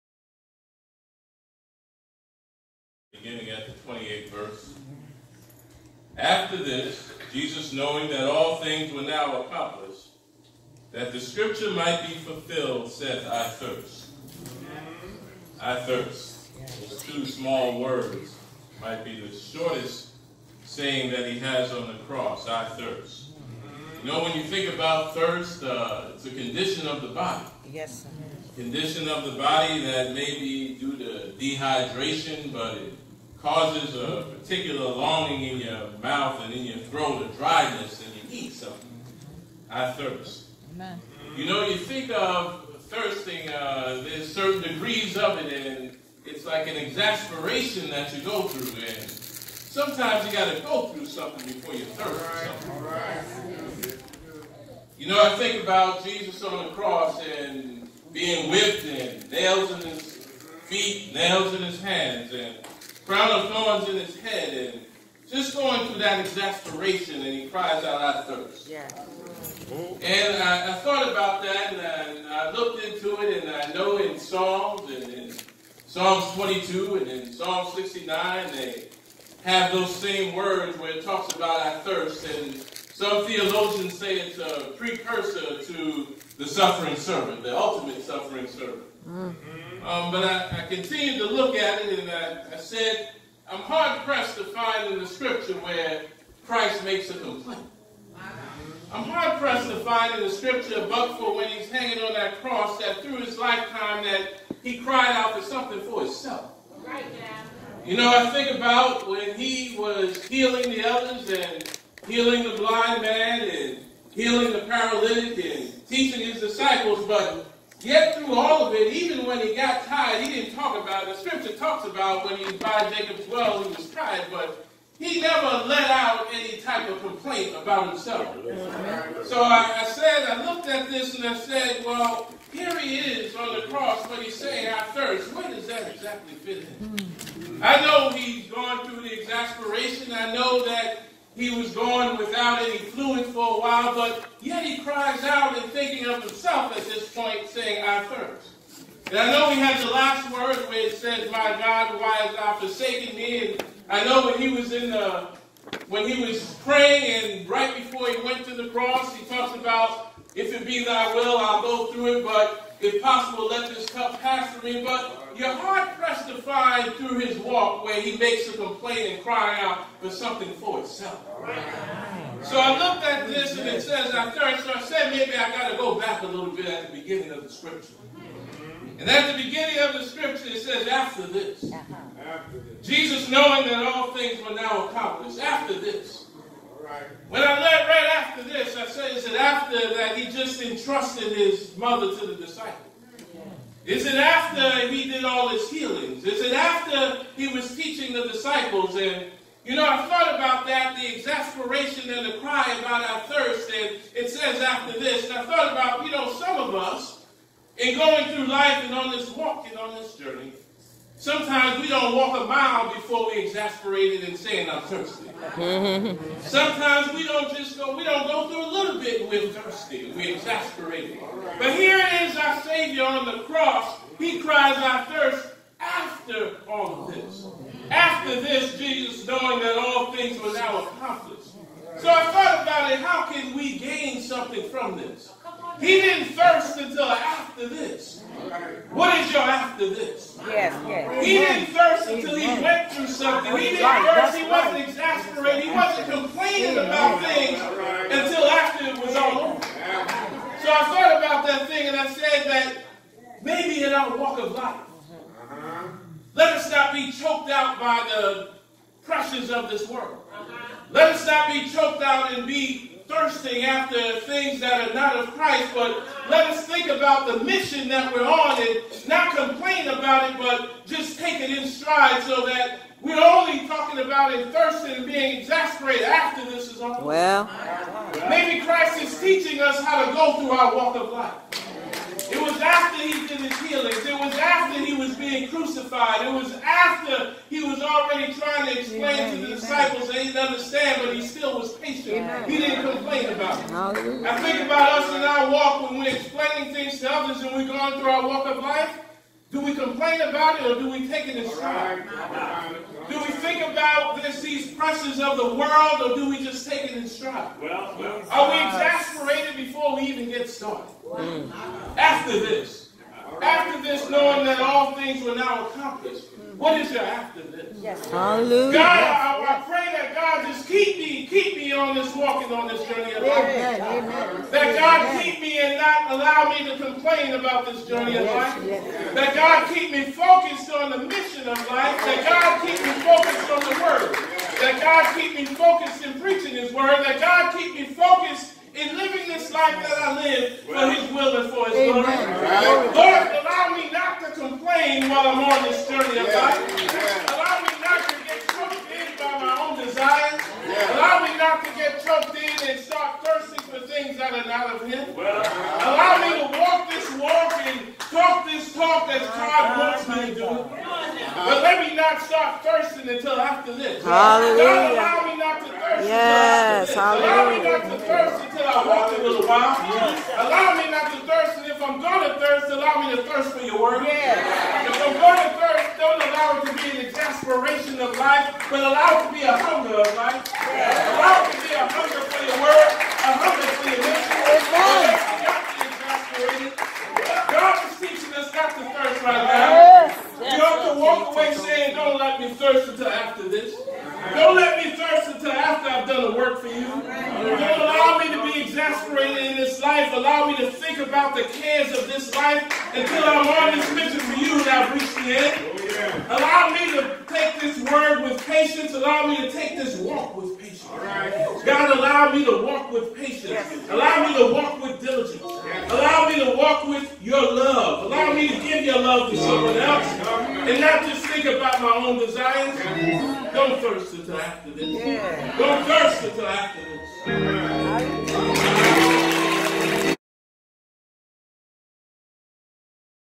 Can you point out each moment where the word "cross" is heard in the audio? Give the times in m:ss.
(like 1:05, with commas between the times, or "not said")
0:22, 0:56, 1:42, 2:13, 2:38, 3:43.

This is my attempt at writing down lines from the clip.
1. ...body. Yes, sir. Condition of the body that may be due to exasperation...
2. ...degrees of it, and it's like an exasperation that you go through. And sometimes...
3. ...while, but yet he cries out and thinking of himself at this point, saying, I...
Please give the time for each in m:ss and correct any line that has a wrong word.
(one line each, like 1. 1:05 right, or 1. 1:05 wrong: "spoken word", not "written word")
1. 0:27 wrong: "dehydration", not "exasperation"
2. 0:44 right
3. 2:23 right.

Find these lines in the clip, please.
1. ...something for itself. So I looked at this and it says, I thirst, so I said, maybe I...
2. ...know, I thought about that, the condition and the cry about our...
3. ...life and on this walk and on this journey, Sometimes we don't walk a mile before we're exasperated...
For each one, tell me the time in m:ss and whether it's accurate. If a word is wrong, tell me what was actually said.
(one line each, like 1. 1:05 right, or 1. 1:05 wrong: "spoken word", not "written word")
1. 2:50 right
2. 3:19 wrong: "exasperation", not "condition"
3. 3:28 right.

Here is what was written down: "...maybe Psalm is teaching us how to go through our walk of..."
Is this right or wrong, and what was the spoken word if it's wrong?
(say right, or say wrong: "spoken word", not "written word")
wrong: "Christ", not "Psalm".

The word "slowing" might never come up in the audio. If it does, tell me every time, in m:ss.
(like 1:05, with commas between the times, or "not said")
not said.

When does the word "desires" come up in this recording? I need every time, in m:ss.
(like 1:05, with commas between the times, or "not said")
5:49, 7:02.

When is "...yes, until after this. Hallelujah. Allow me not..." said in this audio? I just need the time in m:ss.
6:06.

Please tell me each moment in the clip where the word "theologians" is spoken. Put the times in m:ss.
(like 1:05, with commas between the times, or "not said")
1:23.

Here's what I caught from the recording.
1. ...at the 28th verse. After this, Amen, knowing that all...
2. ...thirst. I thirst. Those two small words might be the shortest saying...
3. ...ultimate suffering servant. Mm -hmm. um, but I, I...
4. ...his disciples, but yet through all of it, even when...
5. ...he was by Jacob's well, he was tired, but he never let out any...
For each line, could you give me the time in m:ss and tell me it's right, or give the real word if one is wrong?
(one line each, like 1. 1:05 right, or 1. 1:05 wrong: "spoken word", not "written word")
1. 0:03 wrong: "Jesus", not "Amen"
2. 0:13 right
3. 1:27 right
4. 1:56 right
5. 2:02 right.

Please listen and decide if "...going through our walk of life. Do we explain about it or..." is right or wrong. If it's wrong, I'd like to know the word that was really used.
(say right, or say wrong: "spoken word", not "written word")
wrong: "complain", not "explain".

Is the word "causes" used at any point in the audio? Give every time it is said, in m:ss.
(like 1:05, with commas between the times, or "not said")
0:33.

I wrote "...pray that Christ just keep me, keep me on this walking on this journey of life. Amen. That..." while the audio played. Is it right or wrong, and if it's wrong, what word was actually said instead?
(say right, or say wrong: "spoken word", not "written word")
wrong: "God", not "Christ".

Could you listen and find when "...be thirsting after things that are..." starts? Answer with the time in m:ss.
4:22.